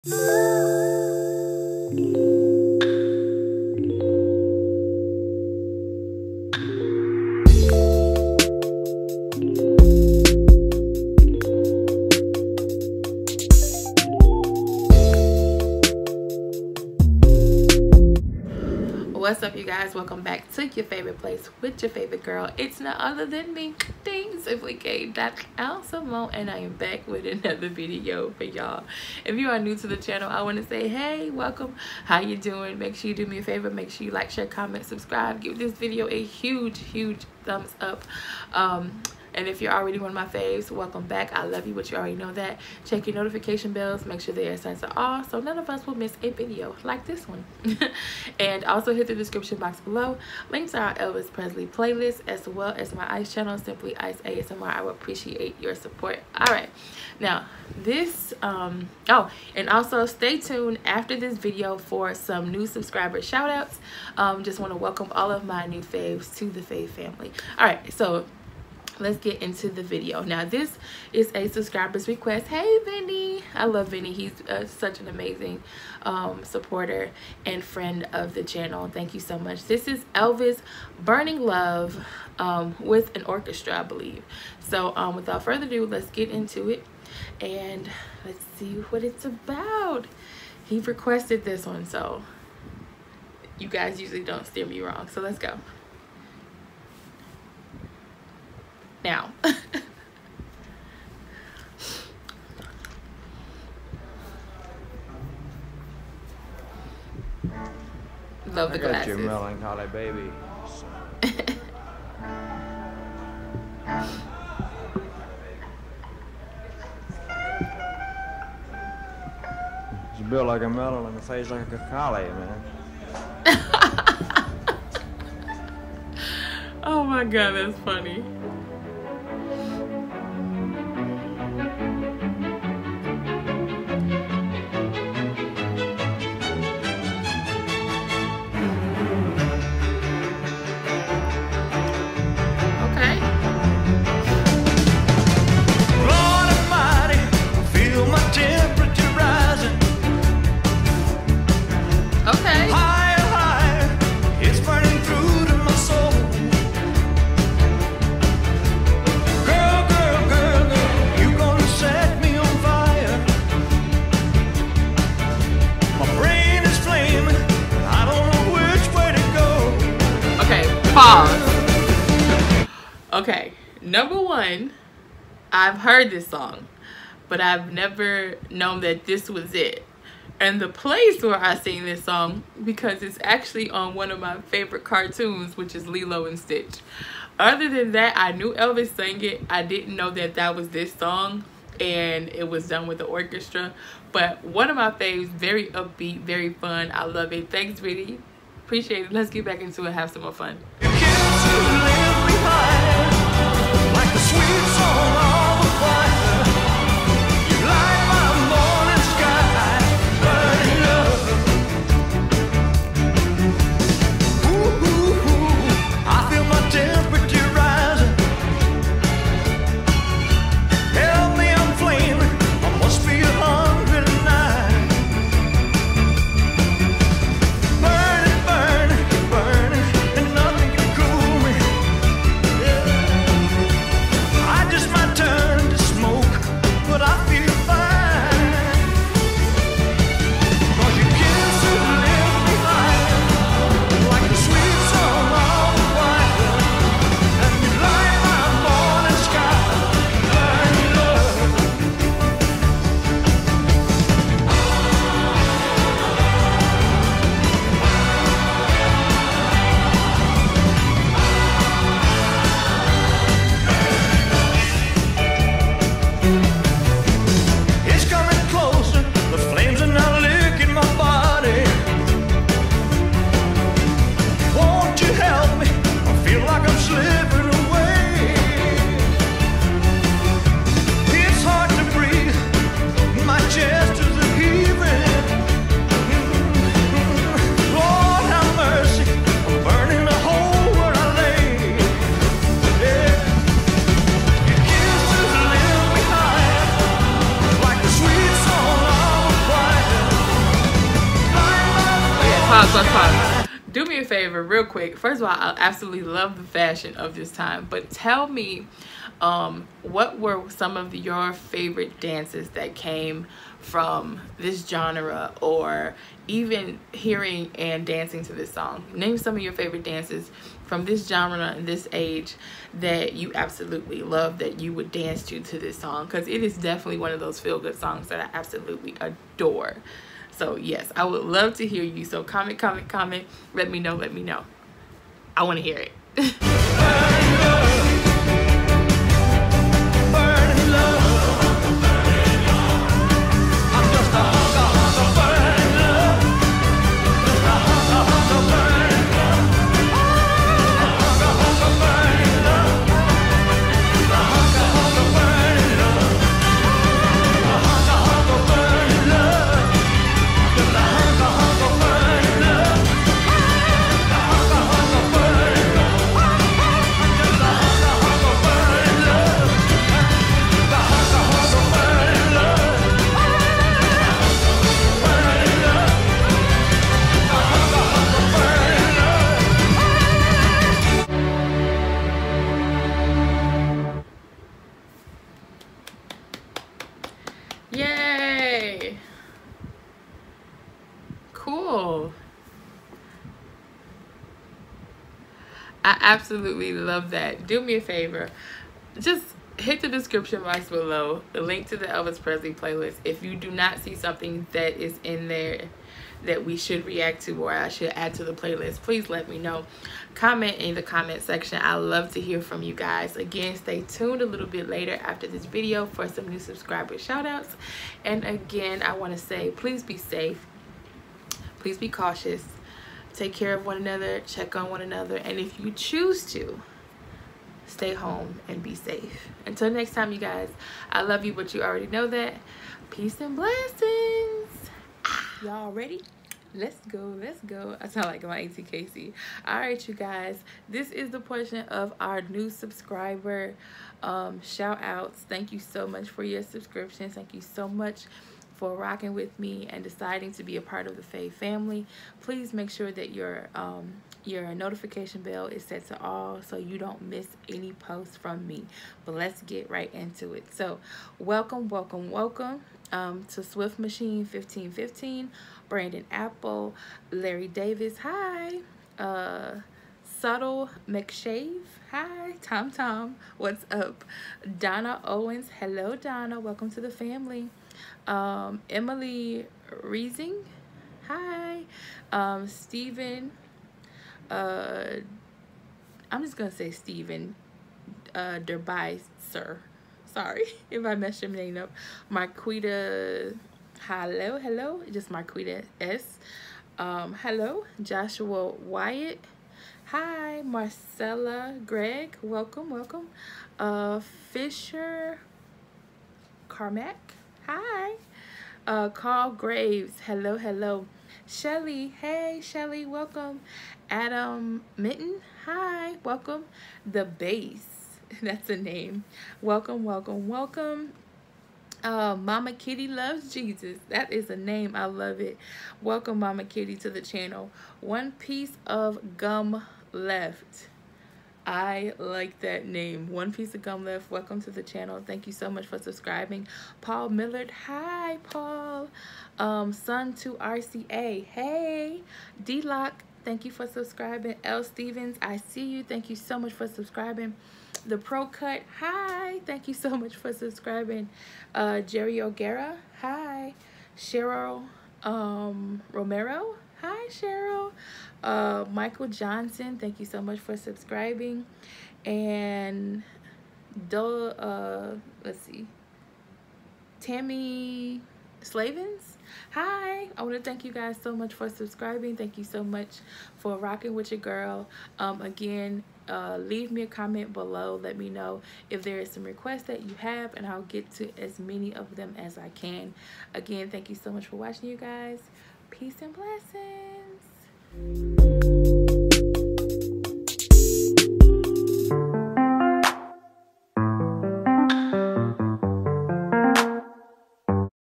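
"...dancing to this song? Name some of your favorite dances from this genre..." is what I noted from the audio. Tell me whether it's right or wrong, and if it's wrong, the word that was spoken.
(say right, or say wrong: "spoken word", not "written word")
right.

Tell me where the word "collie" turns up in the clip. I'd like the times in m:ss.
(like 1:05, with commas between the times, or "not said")
2:01.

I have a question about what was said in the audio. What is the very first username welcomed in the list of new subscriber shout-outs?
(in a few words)
Swift Machine 1515.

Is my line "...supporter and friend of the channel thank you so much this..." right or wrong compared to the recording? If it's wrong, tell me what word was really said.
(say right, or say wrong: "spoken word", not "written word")
right.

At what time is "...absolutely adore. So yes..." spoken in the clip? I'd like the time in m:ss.
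5:28.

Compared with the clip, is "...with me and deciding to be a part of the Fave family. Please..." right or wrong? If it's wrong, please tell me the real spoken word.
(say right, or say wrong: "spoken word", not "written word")
right.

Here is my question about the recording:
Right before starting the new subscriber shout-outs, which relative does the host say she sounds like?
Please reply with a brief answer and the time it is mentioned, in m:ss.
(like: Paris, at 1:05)
auntie Casey, at 7:18.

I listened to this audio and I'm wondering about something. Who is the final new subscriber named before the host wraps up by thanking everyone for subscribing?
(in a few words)
Tammy Slavens.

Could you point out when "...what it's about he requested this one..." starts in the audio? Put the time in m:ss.
1:28.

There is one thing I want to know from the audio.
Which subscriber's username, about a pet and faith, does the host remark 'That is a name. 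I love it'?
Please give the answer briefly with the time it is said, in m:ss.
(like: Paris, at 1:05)
Mama Kitty loves Jesus, at 8:42.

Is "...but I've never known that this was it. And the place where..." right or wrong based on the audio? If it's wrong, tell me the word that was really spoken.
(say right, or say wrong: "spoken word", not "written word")
right.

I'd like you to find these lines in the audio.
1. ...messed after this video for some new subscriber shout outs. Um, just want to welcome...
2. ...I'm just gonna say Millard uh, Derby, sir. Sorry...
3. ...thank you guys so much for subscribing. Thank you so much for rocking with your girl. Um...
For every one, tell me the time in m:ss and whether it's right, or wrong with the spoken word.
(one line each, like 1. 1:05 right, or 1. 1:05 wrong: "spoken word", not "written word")
1. 1:00 wrong: "tuned", not "messed"
2. 8:06 wrong: "Stephen", not "Millard"
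3. 9:30 right.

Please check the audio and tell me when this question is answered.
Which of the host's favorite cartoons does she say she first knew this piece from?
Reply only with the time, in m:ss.
3:05.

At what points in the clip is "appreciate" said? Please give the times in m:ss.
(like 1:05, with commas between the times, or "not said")
0:54, 3:18.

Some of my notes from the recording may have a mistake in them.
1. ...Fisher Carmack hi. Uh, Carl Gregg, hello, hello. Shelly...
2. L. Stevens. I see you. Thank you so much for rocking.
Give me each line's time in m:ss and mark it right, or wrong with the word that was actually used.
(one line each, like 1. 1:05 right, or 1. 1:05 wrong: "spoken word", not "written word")
1. 8:24 wrong: "Graves", not "Gregg"
2. 9:04 wrong: "subscribing", not "rocking".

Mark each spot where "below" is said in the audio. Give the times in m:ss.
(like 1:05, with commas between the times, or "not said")
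0:49, 6:40, 9:37.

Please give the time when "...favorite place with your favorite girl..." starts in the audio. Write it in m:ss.
0:20.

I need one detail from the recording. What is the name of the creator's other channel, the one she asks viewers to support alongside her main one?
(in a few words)
Simply ICE ASMR.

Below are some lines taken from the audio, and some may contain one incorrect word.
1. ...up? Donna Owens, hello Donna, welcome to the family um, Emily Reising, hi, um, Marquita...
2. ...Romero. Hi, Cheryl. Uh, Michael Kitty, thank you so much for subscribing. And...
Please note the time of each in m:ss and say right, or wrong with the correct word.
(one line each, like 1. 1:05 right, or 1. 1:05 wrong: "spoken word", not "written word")
1. 7:53 wrong: "Stephen", not "Marquita"
2. 9:15 wrong: "Johnson", not "Kitty".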